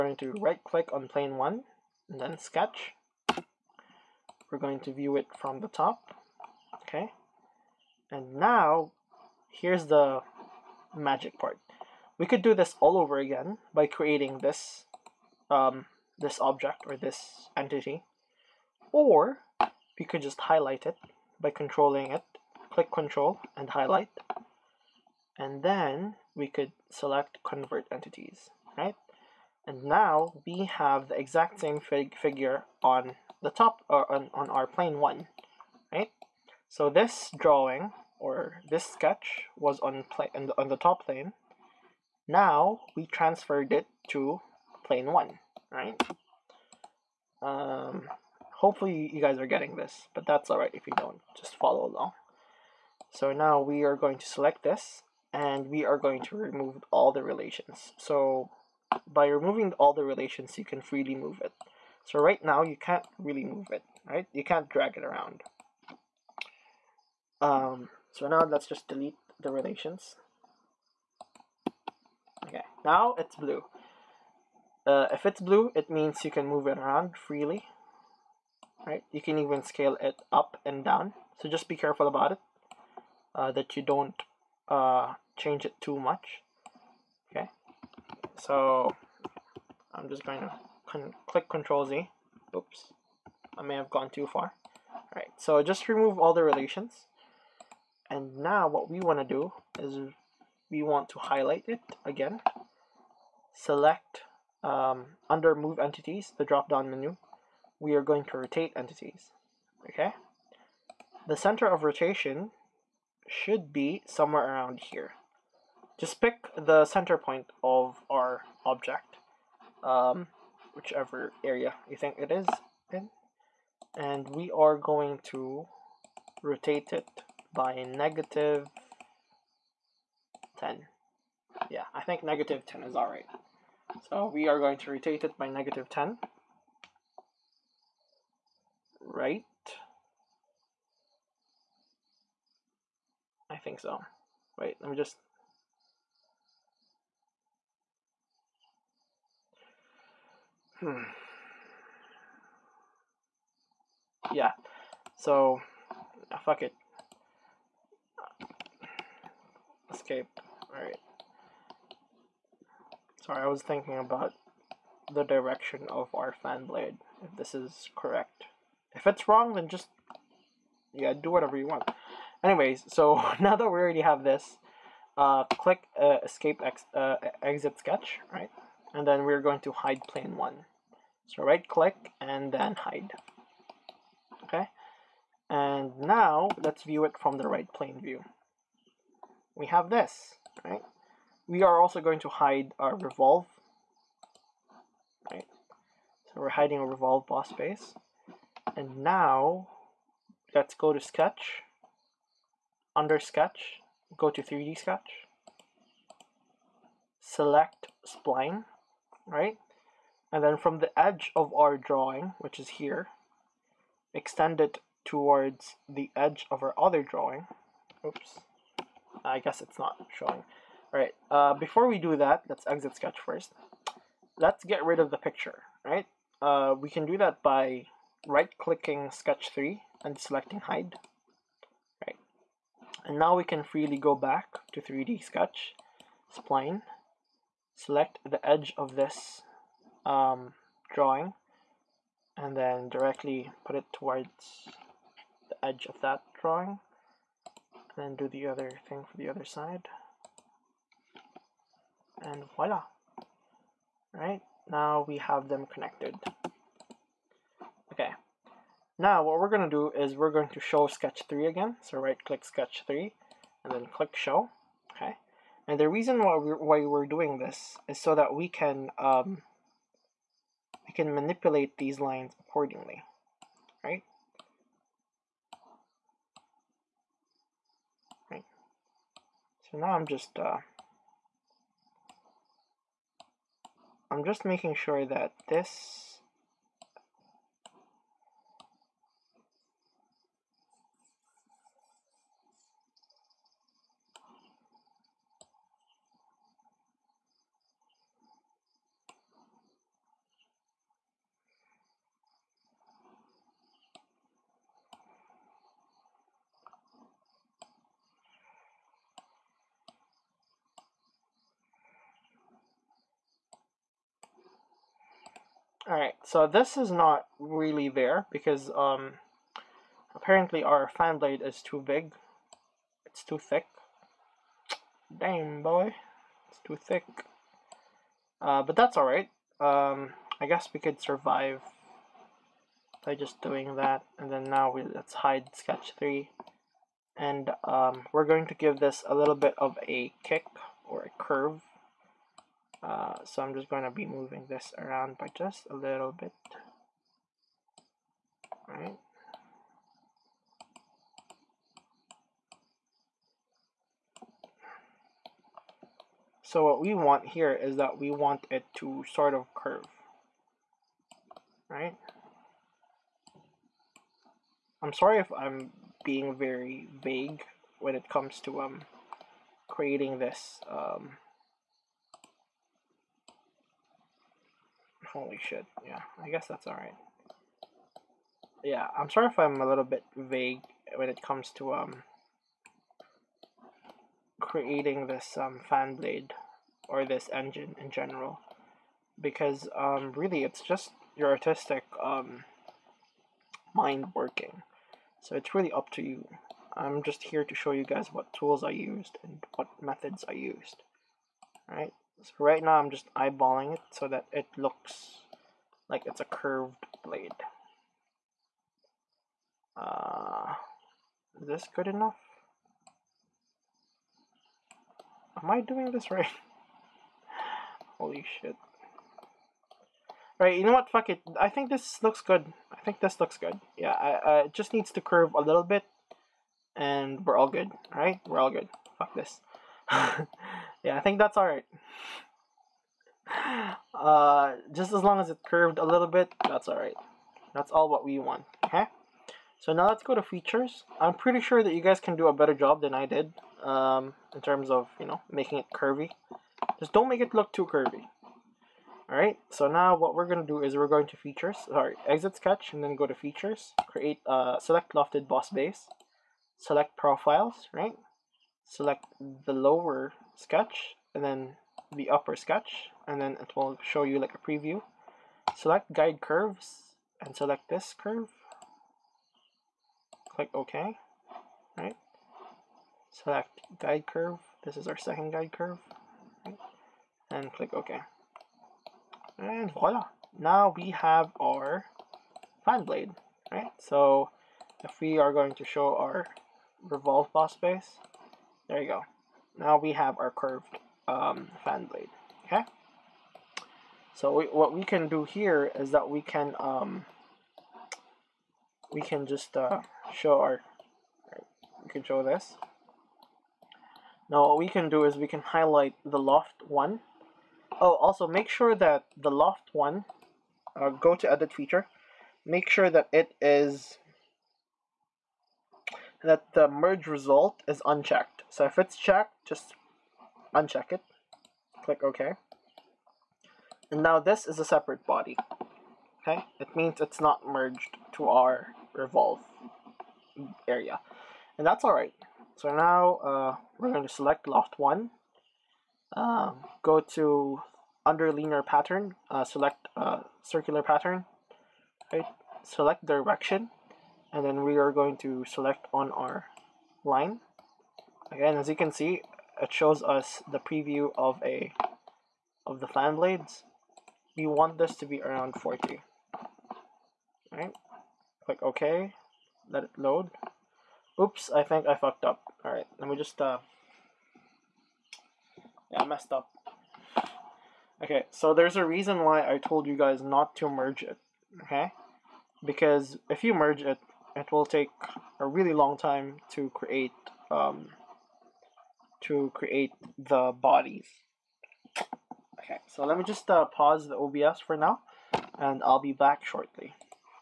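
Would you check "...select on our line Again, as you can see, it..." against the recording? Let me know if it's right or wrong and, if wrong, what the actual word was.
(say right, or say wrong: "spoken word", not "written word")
right.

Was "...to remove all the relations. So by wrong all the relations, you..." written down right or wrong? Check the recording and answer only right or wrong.
wrong.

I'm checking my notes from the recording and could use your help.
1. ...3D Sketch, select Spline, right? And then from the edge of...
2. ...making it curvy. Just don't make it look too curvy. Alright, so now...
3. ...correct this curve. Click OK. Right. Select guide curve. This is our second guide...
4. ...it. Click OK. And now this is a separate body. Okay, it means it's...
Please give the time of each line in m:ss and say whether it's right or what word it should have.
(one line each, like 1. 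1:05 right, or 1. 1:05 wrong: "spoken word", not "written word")
1. 3:24 right
2. 7:25 right
3. 7:47 wrong: "select", not "correct"
4. 8:40 right.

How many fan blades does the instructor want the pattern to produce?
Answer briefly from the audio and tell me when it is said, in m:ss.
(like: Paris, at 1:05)
40, at 9:15.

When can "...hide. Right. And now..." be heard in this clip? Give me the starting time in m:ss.
3:50.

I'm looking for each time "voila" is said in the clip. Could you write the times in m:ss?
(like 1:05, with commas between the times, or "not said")
4:12, 7:59.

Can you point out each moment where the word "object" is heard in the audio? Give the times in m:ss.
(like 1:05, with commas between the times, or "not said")
0:16, 1:58.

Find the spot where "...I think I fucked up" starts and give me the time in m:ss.
9:21.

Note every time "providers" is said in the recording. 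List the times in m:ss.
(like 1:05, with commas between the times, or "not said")
not said.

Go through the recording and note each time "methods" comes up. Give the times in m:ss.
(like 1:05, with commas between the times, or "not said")
6:39.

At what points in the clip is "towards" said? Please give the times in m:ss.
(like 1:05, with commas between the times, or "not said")
3:35, 4:03.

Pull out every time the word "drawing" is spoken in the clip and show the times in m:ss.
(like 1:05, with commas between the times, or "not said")
0:37, 3:31, 3:37, 4:00, 4:06.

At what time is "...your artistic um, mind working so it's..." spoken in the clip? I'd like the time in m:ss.
6:31.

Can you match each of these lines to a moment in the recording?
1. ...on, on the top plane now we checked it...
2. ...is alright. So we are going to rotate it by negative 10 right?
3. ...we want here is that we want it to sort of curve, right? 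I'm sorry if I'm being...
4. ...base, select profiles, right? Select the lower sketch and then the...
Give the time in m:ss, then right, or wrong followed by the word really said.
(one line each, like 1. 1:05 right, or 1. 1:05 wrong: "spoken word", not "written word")
1. 0:40 wrong: "transferred", not "checked"
2. 2:12 right
3. 5:56 right
4. 7:35 right.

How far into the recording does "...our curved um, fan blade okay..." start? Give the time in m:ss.
8:10.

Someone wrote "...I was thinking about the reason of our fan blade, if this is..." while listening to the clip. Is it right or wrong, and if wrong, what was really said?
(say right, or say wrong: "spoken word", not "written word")
wrong: "direction", not "reason".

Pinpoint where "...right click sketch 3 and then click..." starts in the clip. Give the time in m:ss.
4:21.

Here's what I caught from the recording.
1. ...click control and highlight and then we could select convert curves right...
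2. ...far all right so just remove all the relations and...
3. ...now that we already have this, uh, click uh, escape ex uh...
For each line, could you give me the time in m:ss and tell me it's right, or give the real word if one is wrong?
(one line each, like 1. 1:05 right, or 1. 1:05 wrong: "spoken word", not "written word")
1. 0:22 wrong: "entities", not "curves"
2. 1:34 right
3. 2:53 right.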